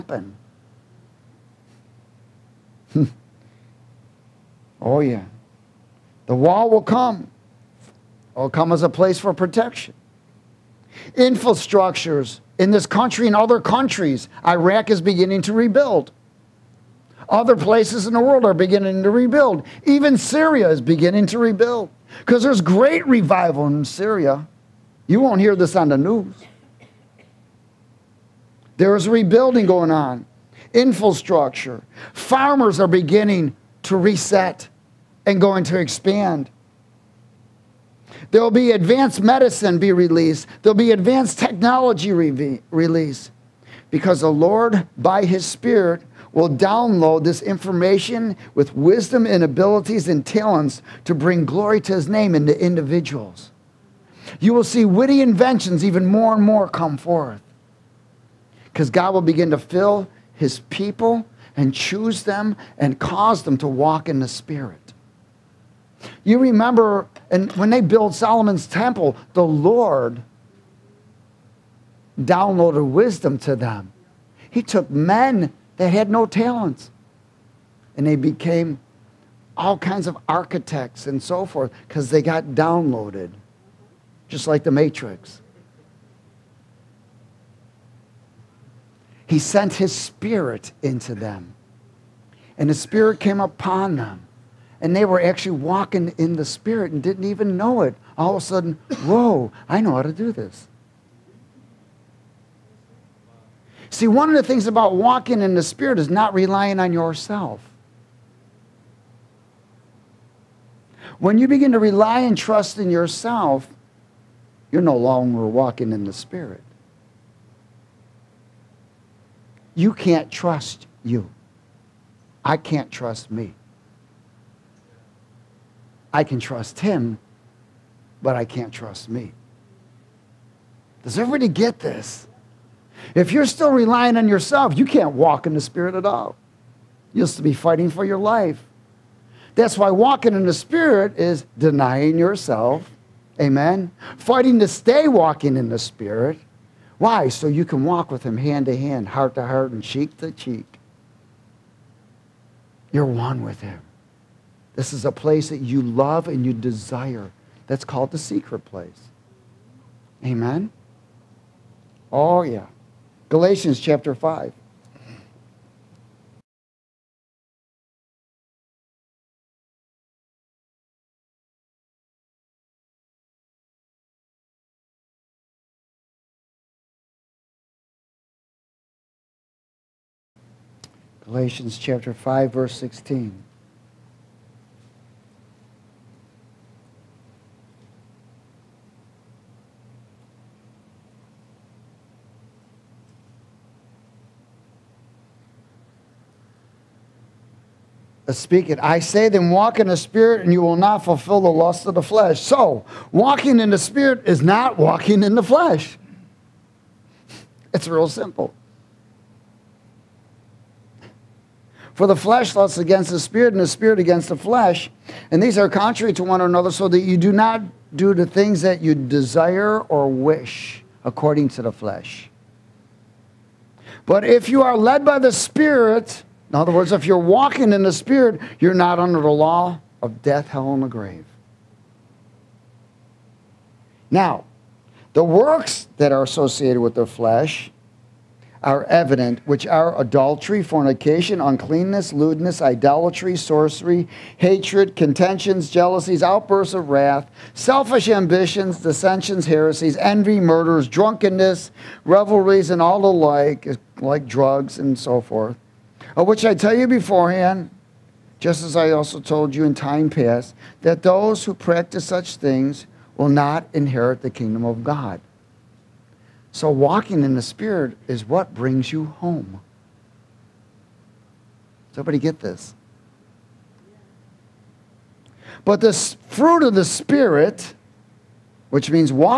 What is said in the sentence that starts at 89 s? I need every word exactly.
He sent his spirit into them, and the spirit came upon them.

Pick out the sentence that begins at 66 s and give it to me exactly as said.
You remember, and when they built Solomon's temple, the Lord downloaded wisdom to them.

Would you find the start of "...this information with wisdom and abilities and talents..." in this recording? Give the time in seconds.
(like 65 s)
47 s.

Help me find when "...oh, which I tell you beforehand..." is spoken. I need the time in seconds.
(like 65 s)
256 s.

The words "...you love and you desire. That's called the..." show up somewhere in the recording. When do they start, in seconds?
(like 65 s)
155 s.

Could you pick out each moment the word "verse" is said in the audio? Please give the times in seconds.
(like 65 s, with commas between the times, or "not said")
182 s.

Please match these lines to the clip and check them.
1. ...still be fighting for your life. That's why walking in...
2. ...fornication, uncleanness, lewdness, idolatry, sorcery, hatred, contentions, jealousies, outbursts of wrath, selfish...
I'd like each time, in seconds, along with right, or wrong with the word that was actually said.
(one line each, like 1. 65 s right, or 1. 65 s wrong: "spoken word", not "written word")
1. 137 s right
2. 240 s right.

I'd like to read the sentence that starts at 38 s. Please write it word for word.
There will be advanced medicine be released.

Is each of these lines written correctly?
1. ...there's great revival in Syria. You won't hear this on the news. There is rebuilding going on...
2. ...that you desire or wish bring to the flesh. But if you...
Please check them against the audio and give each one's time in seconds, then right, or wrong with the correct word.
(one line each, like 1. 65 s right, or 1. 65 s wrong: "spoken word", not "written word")
1. 22 s right
2. 218 s wrong: "according", not "bring".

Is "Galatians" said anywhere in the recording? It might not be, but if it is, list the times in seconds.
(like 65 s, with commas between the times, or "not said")
163 s, 181 s.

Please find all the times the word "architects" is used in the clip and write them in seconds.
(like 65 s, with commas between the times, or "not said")
80 s.